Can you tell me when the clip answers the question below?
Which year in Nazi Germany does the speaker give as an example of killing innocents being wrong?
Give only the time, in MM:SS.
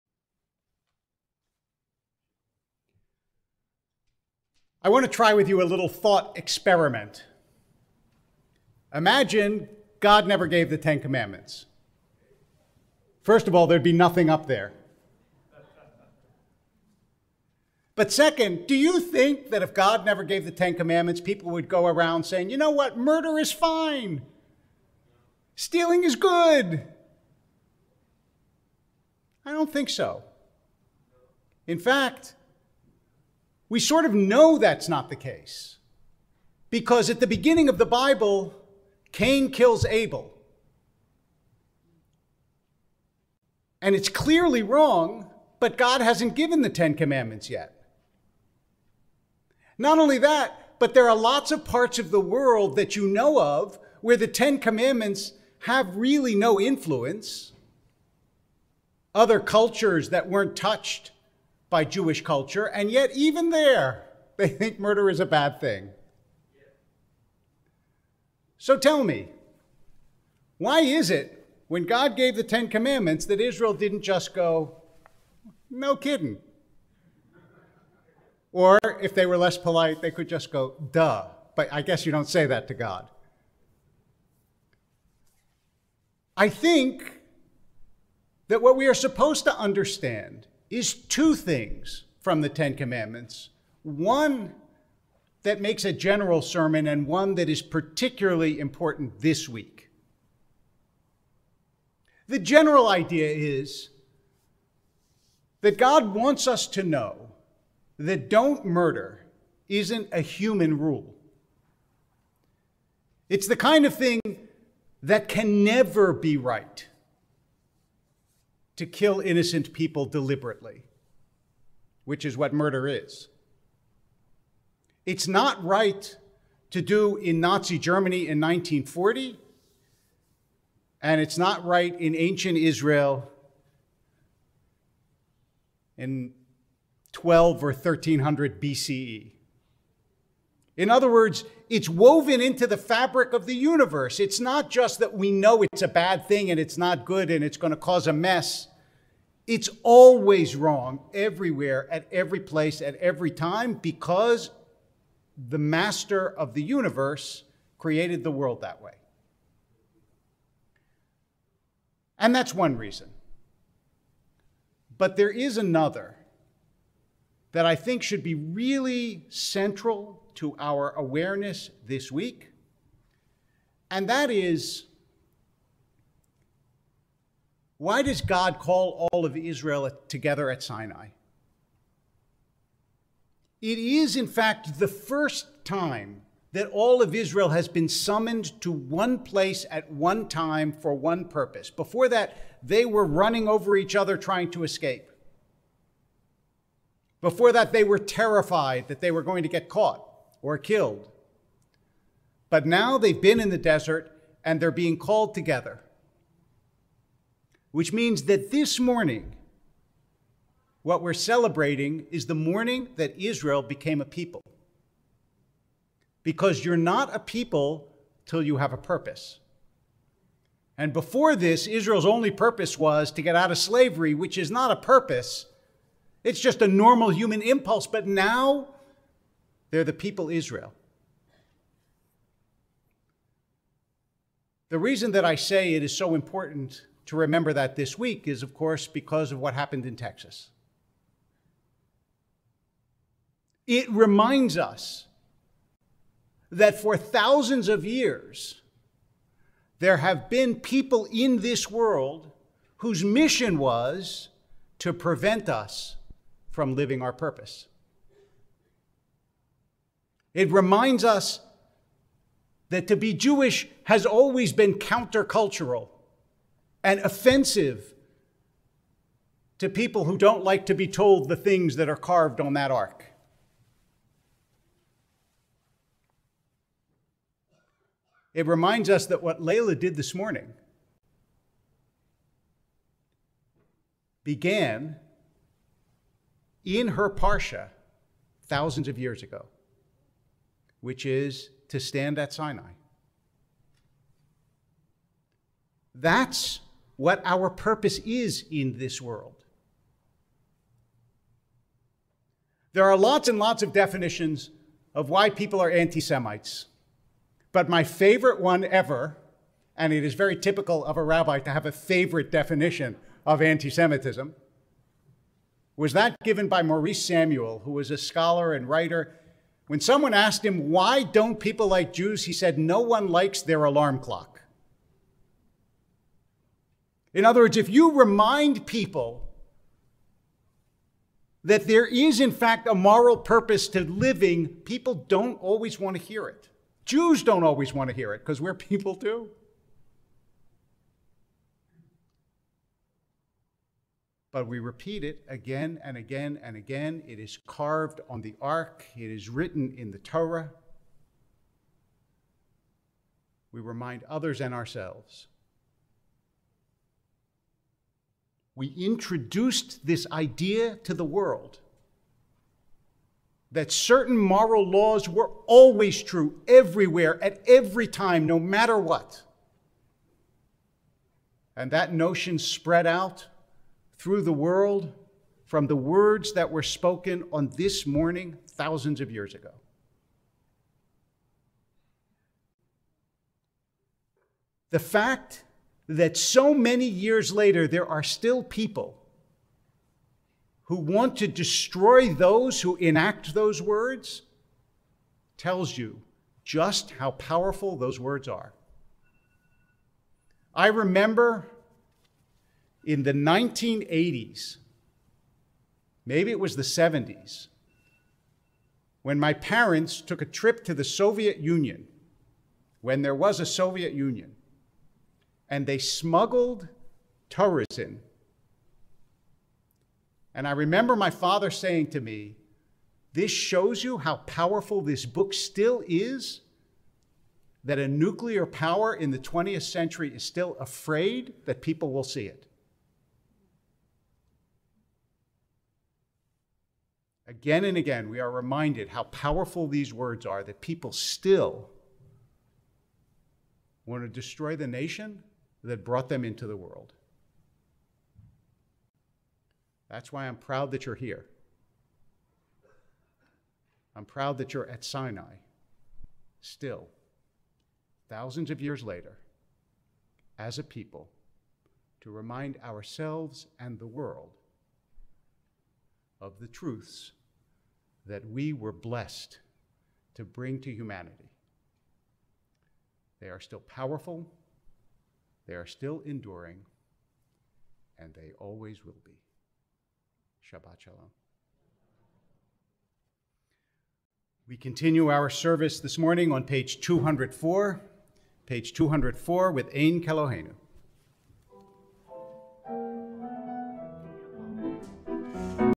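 02:08.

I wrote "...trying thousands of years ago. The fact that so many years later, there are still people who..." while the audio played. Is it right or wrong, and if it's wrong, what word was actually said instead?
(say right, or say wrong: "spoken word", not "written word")
wrong: "morning", not "trying".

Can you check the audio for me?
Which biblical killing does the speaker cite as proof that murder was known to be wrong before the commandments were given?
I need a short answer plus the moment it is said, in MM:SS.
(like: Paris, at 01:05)
Cain kills Abel, at 00:39.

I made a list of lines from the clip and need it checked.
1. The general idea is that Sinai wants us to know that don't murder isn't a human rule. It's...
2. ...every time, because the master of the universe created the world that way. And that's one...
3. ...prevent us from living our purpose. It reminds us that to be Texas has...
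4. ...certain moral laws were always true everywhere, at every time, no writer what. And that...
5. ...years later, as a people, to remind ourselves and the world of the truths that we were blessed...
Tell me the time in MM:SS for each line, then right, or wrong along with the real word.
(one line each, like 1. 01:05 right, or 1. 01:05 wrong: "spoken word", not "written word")
1. 01:42 wrong: "God", not "Sinai"
2. 02:32 right
3. 04:14 wrong: "Jewish", not "Texas"
4. 06:03 wrong: "matter", not "writer"
5. 07:38 right.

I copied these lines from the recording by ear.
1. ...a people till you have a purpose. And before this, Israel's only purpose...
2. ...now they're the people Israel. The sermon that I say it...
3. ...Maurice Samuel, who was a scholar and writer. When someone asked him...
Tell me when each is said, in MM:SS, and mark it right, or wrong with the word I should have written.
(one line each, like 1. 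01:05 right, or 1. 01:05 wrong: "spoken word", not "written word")
1. 03:37 right
2. 03:48 wrong: "reason", not "sermon"
3. 05:16 right.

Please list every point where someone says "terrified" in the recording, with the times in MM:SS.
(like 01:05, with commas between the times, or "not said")
03:17.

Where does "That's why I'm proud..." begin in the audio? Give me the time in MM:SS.
07:29.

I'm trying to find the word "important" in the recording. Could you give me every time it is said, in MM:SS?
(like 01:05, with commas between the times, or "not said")
01:38, 03:56.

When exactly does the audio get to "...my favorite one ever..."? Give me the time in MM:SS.
05:07.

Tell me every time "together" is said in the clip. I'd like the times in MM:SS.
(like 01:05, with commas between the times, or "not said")
03:00, 03:25.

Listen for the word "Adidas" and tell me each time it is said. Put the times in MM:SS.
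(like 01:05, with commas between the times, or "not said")
not said.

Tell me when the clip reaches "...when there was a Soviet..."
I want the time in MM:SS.
06:52.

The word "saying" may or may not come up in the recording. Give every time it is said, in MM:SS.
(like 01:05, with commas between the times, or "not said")
00:22, 07:01.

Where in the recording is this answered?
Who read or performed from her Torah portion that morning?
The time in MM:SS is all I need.
04:39.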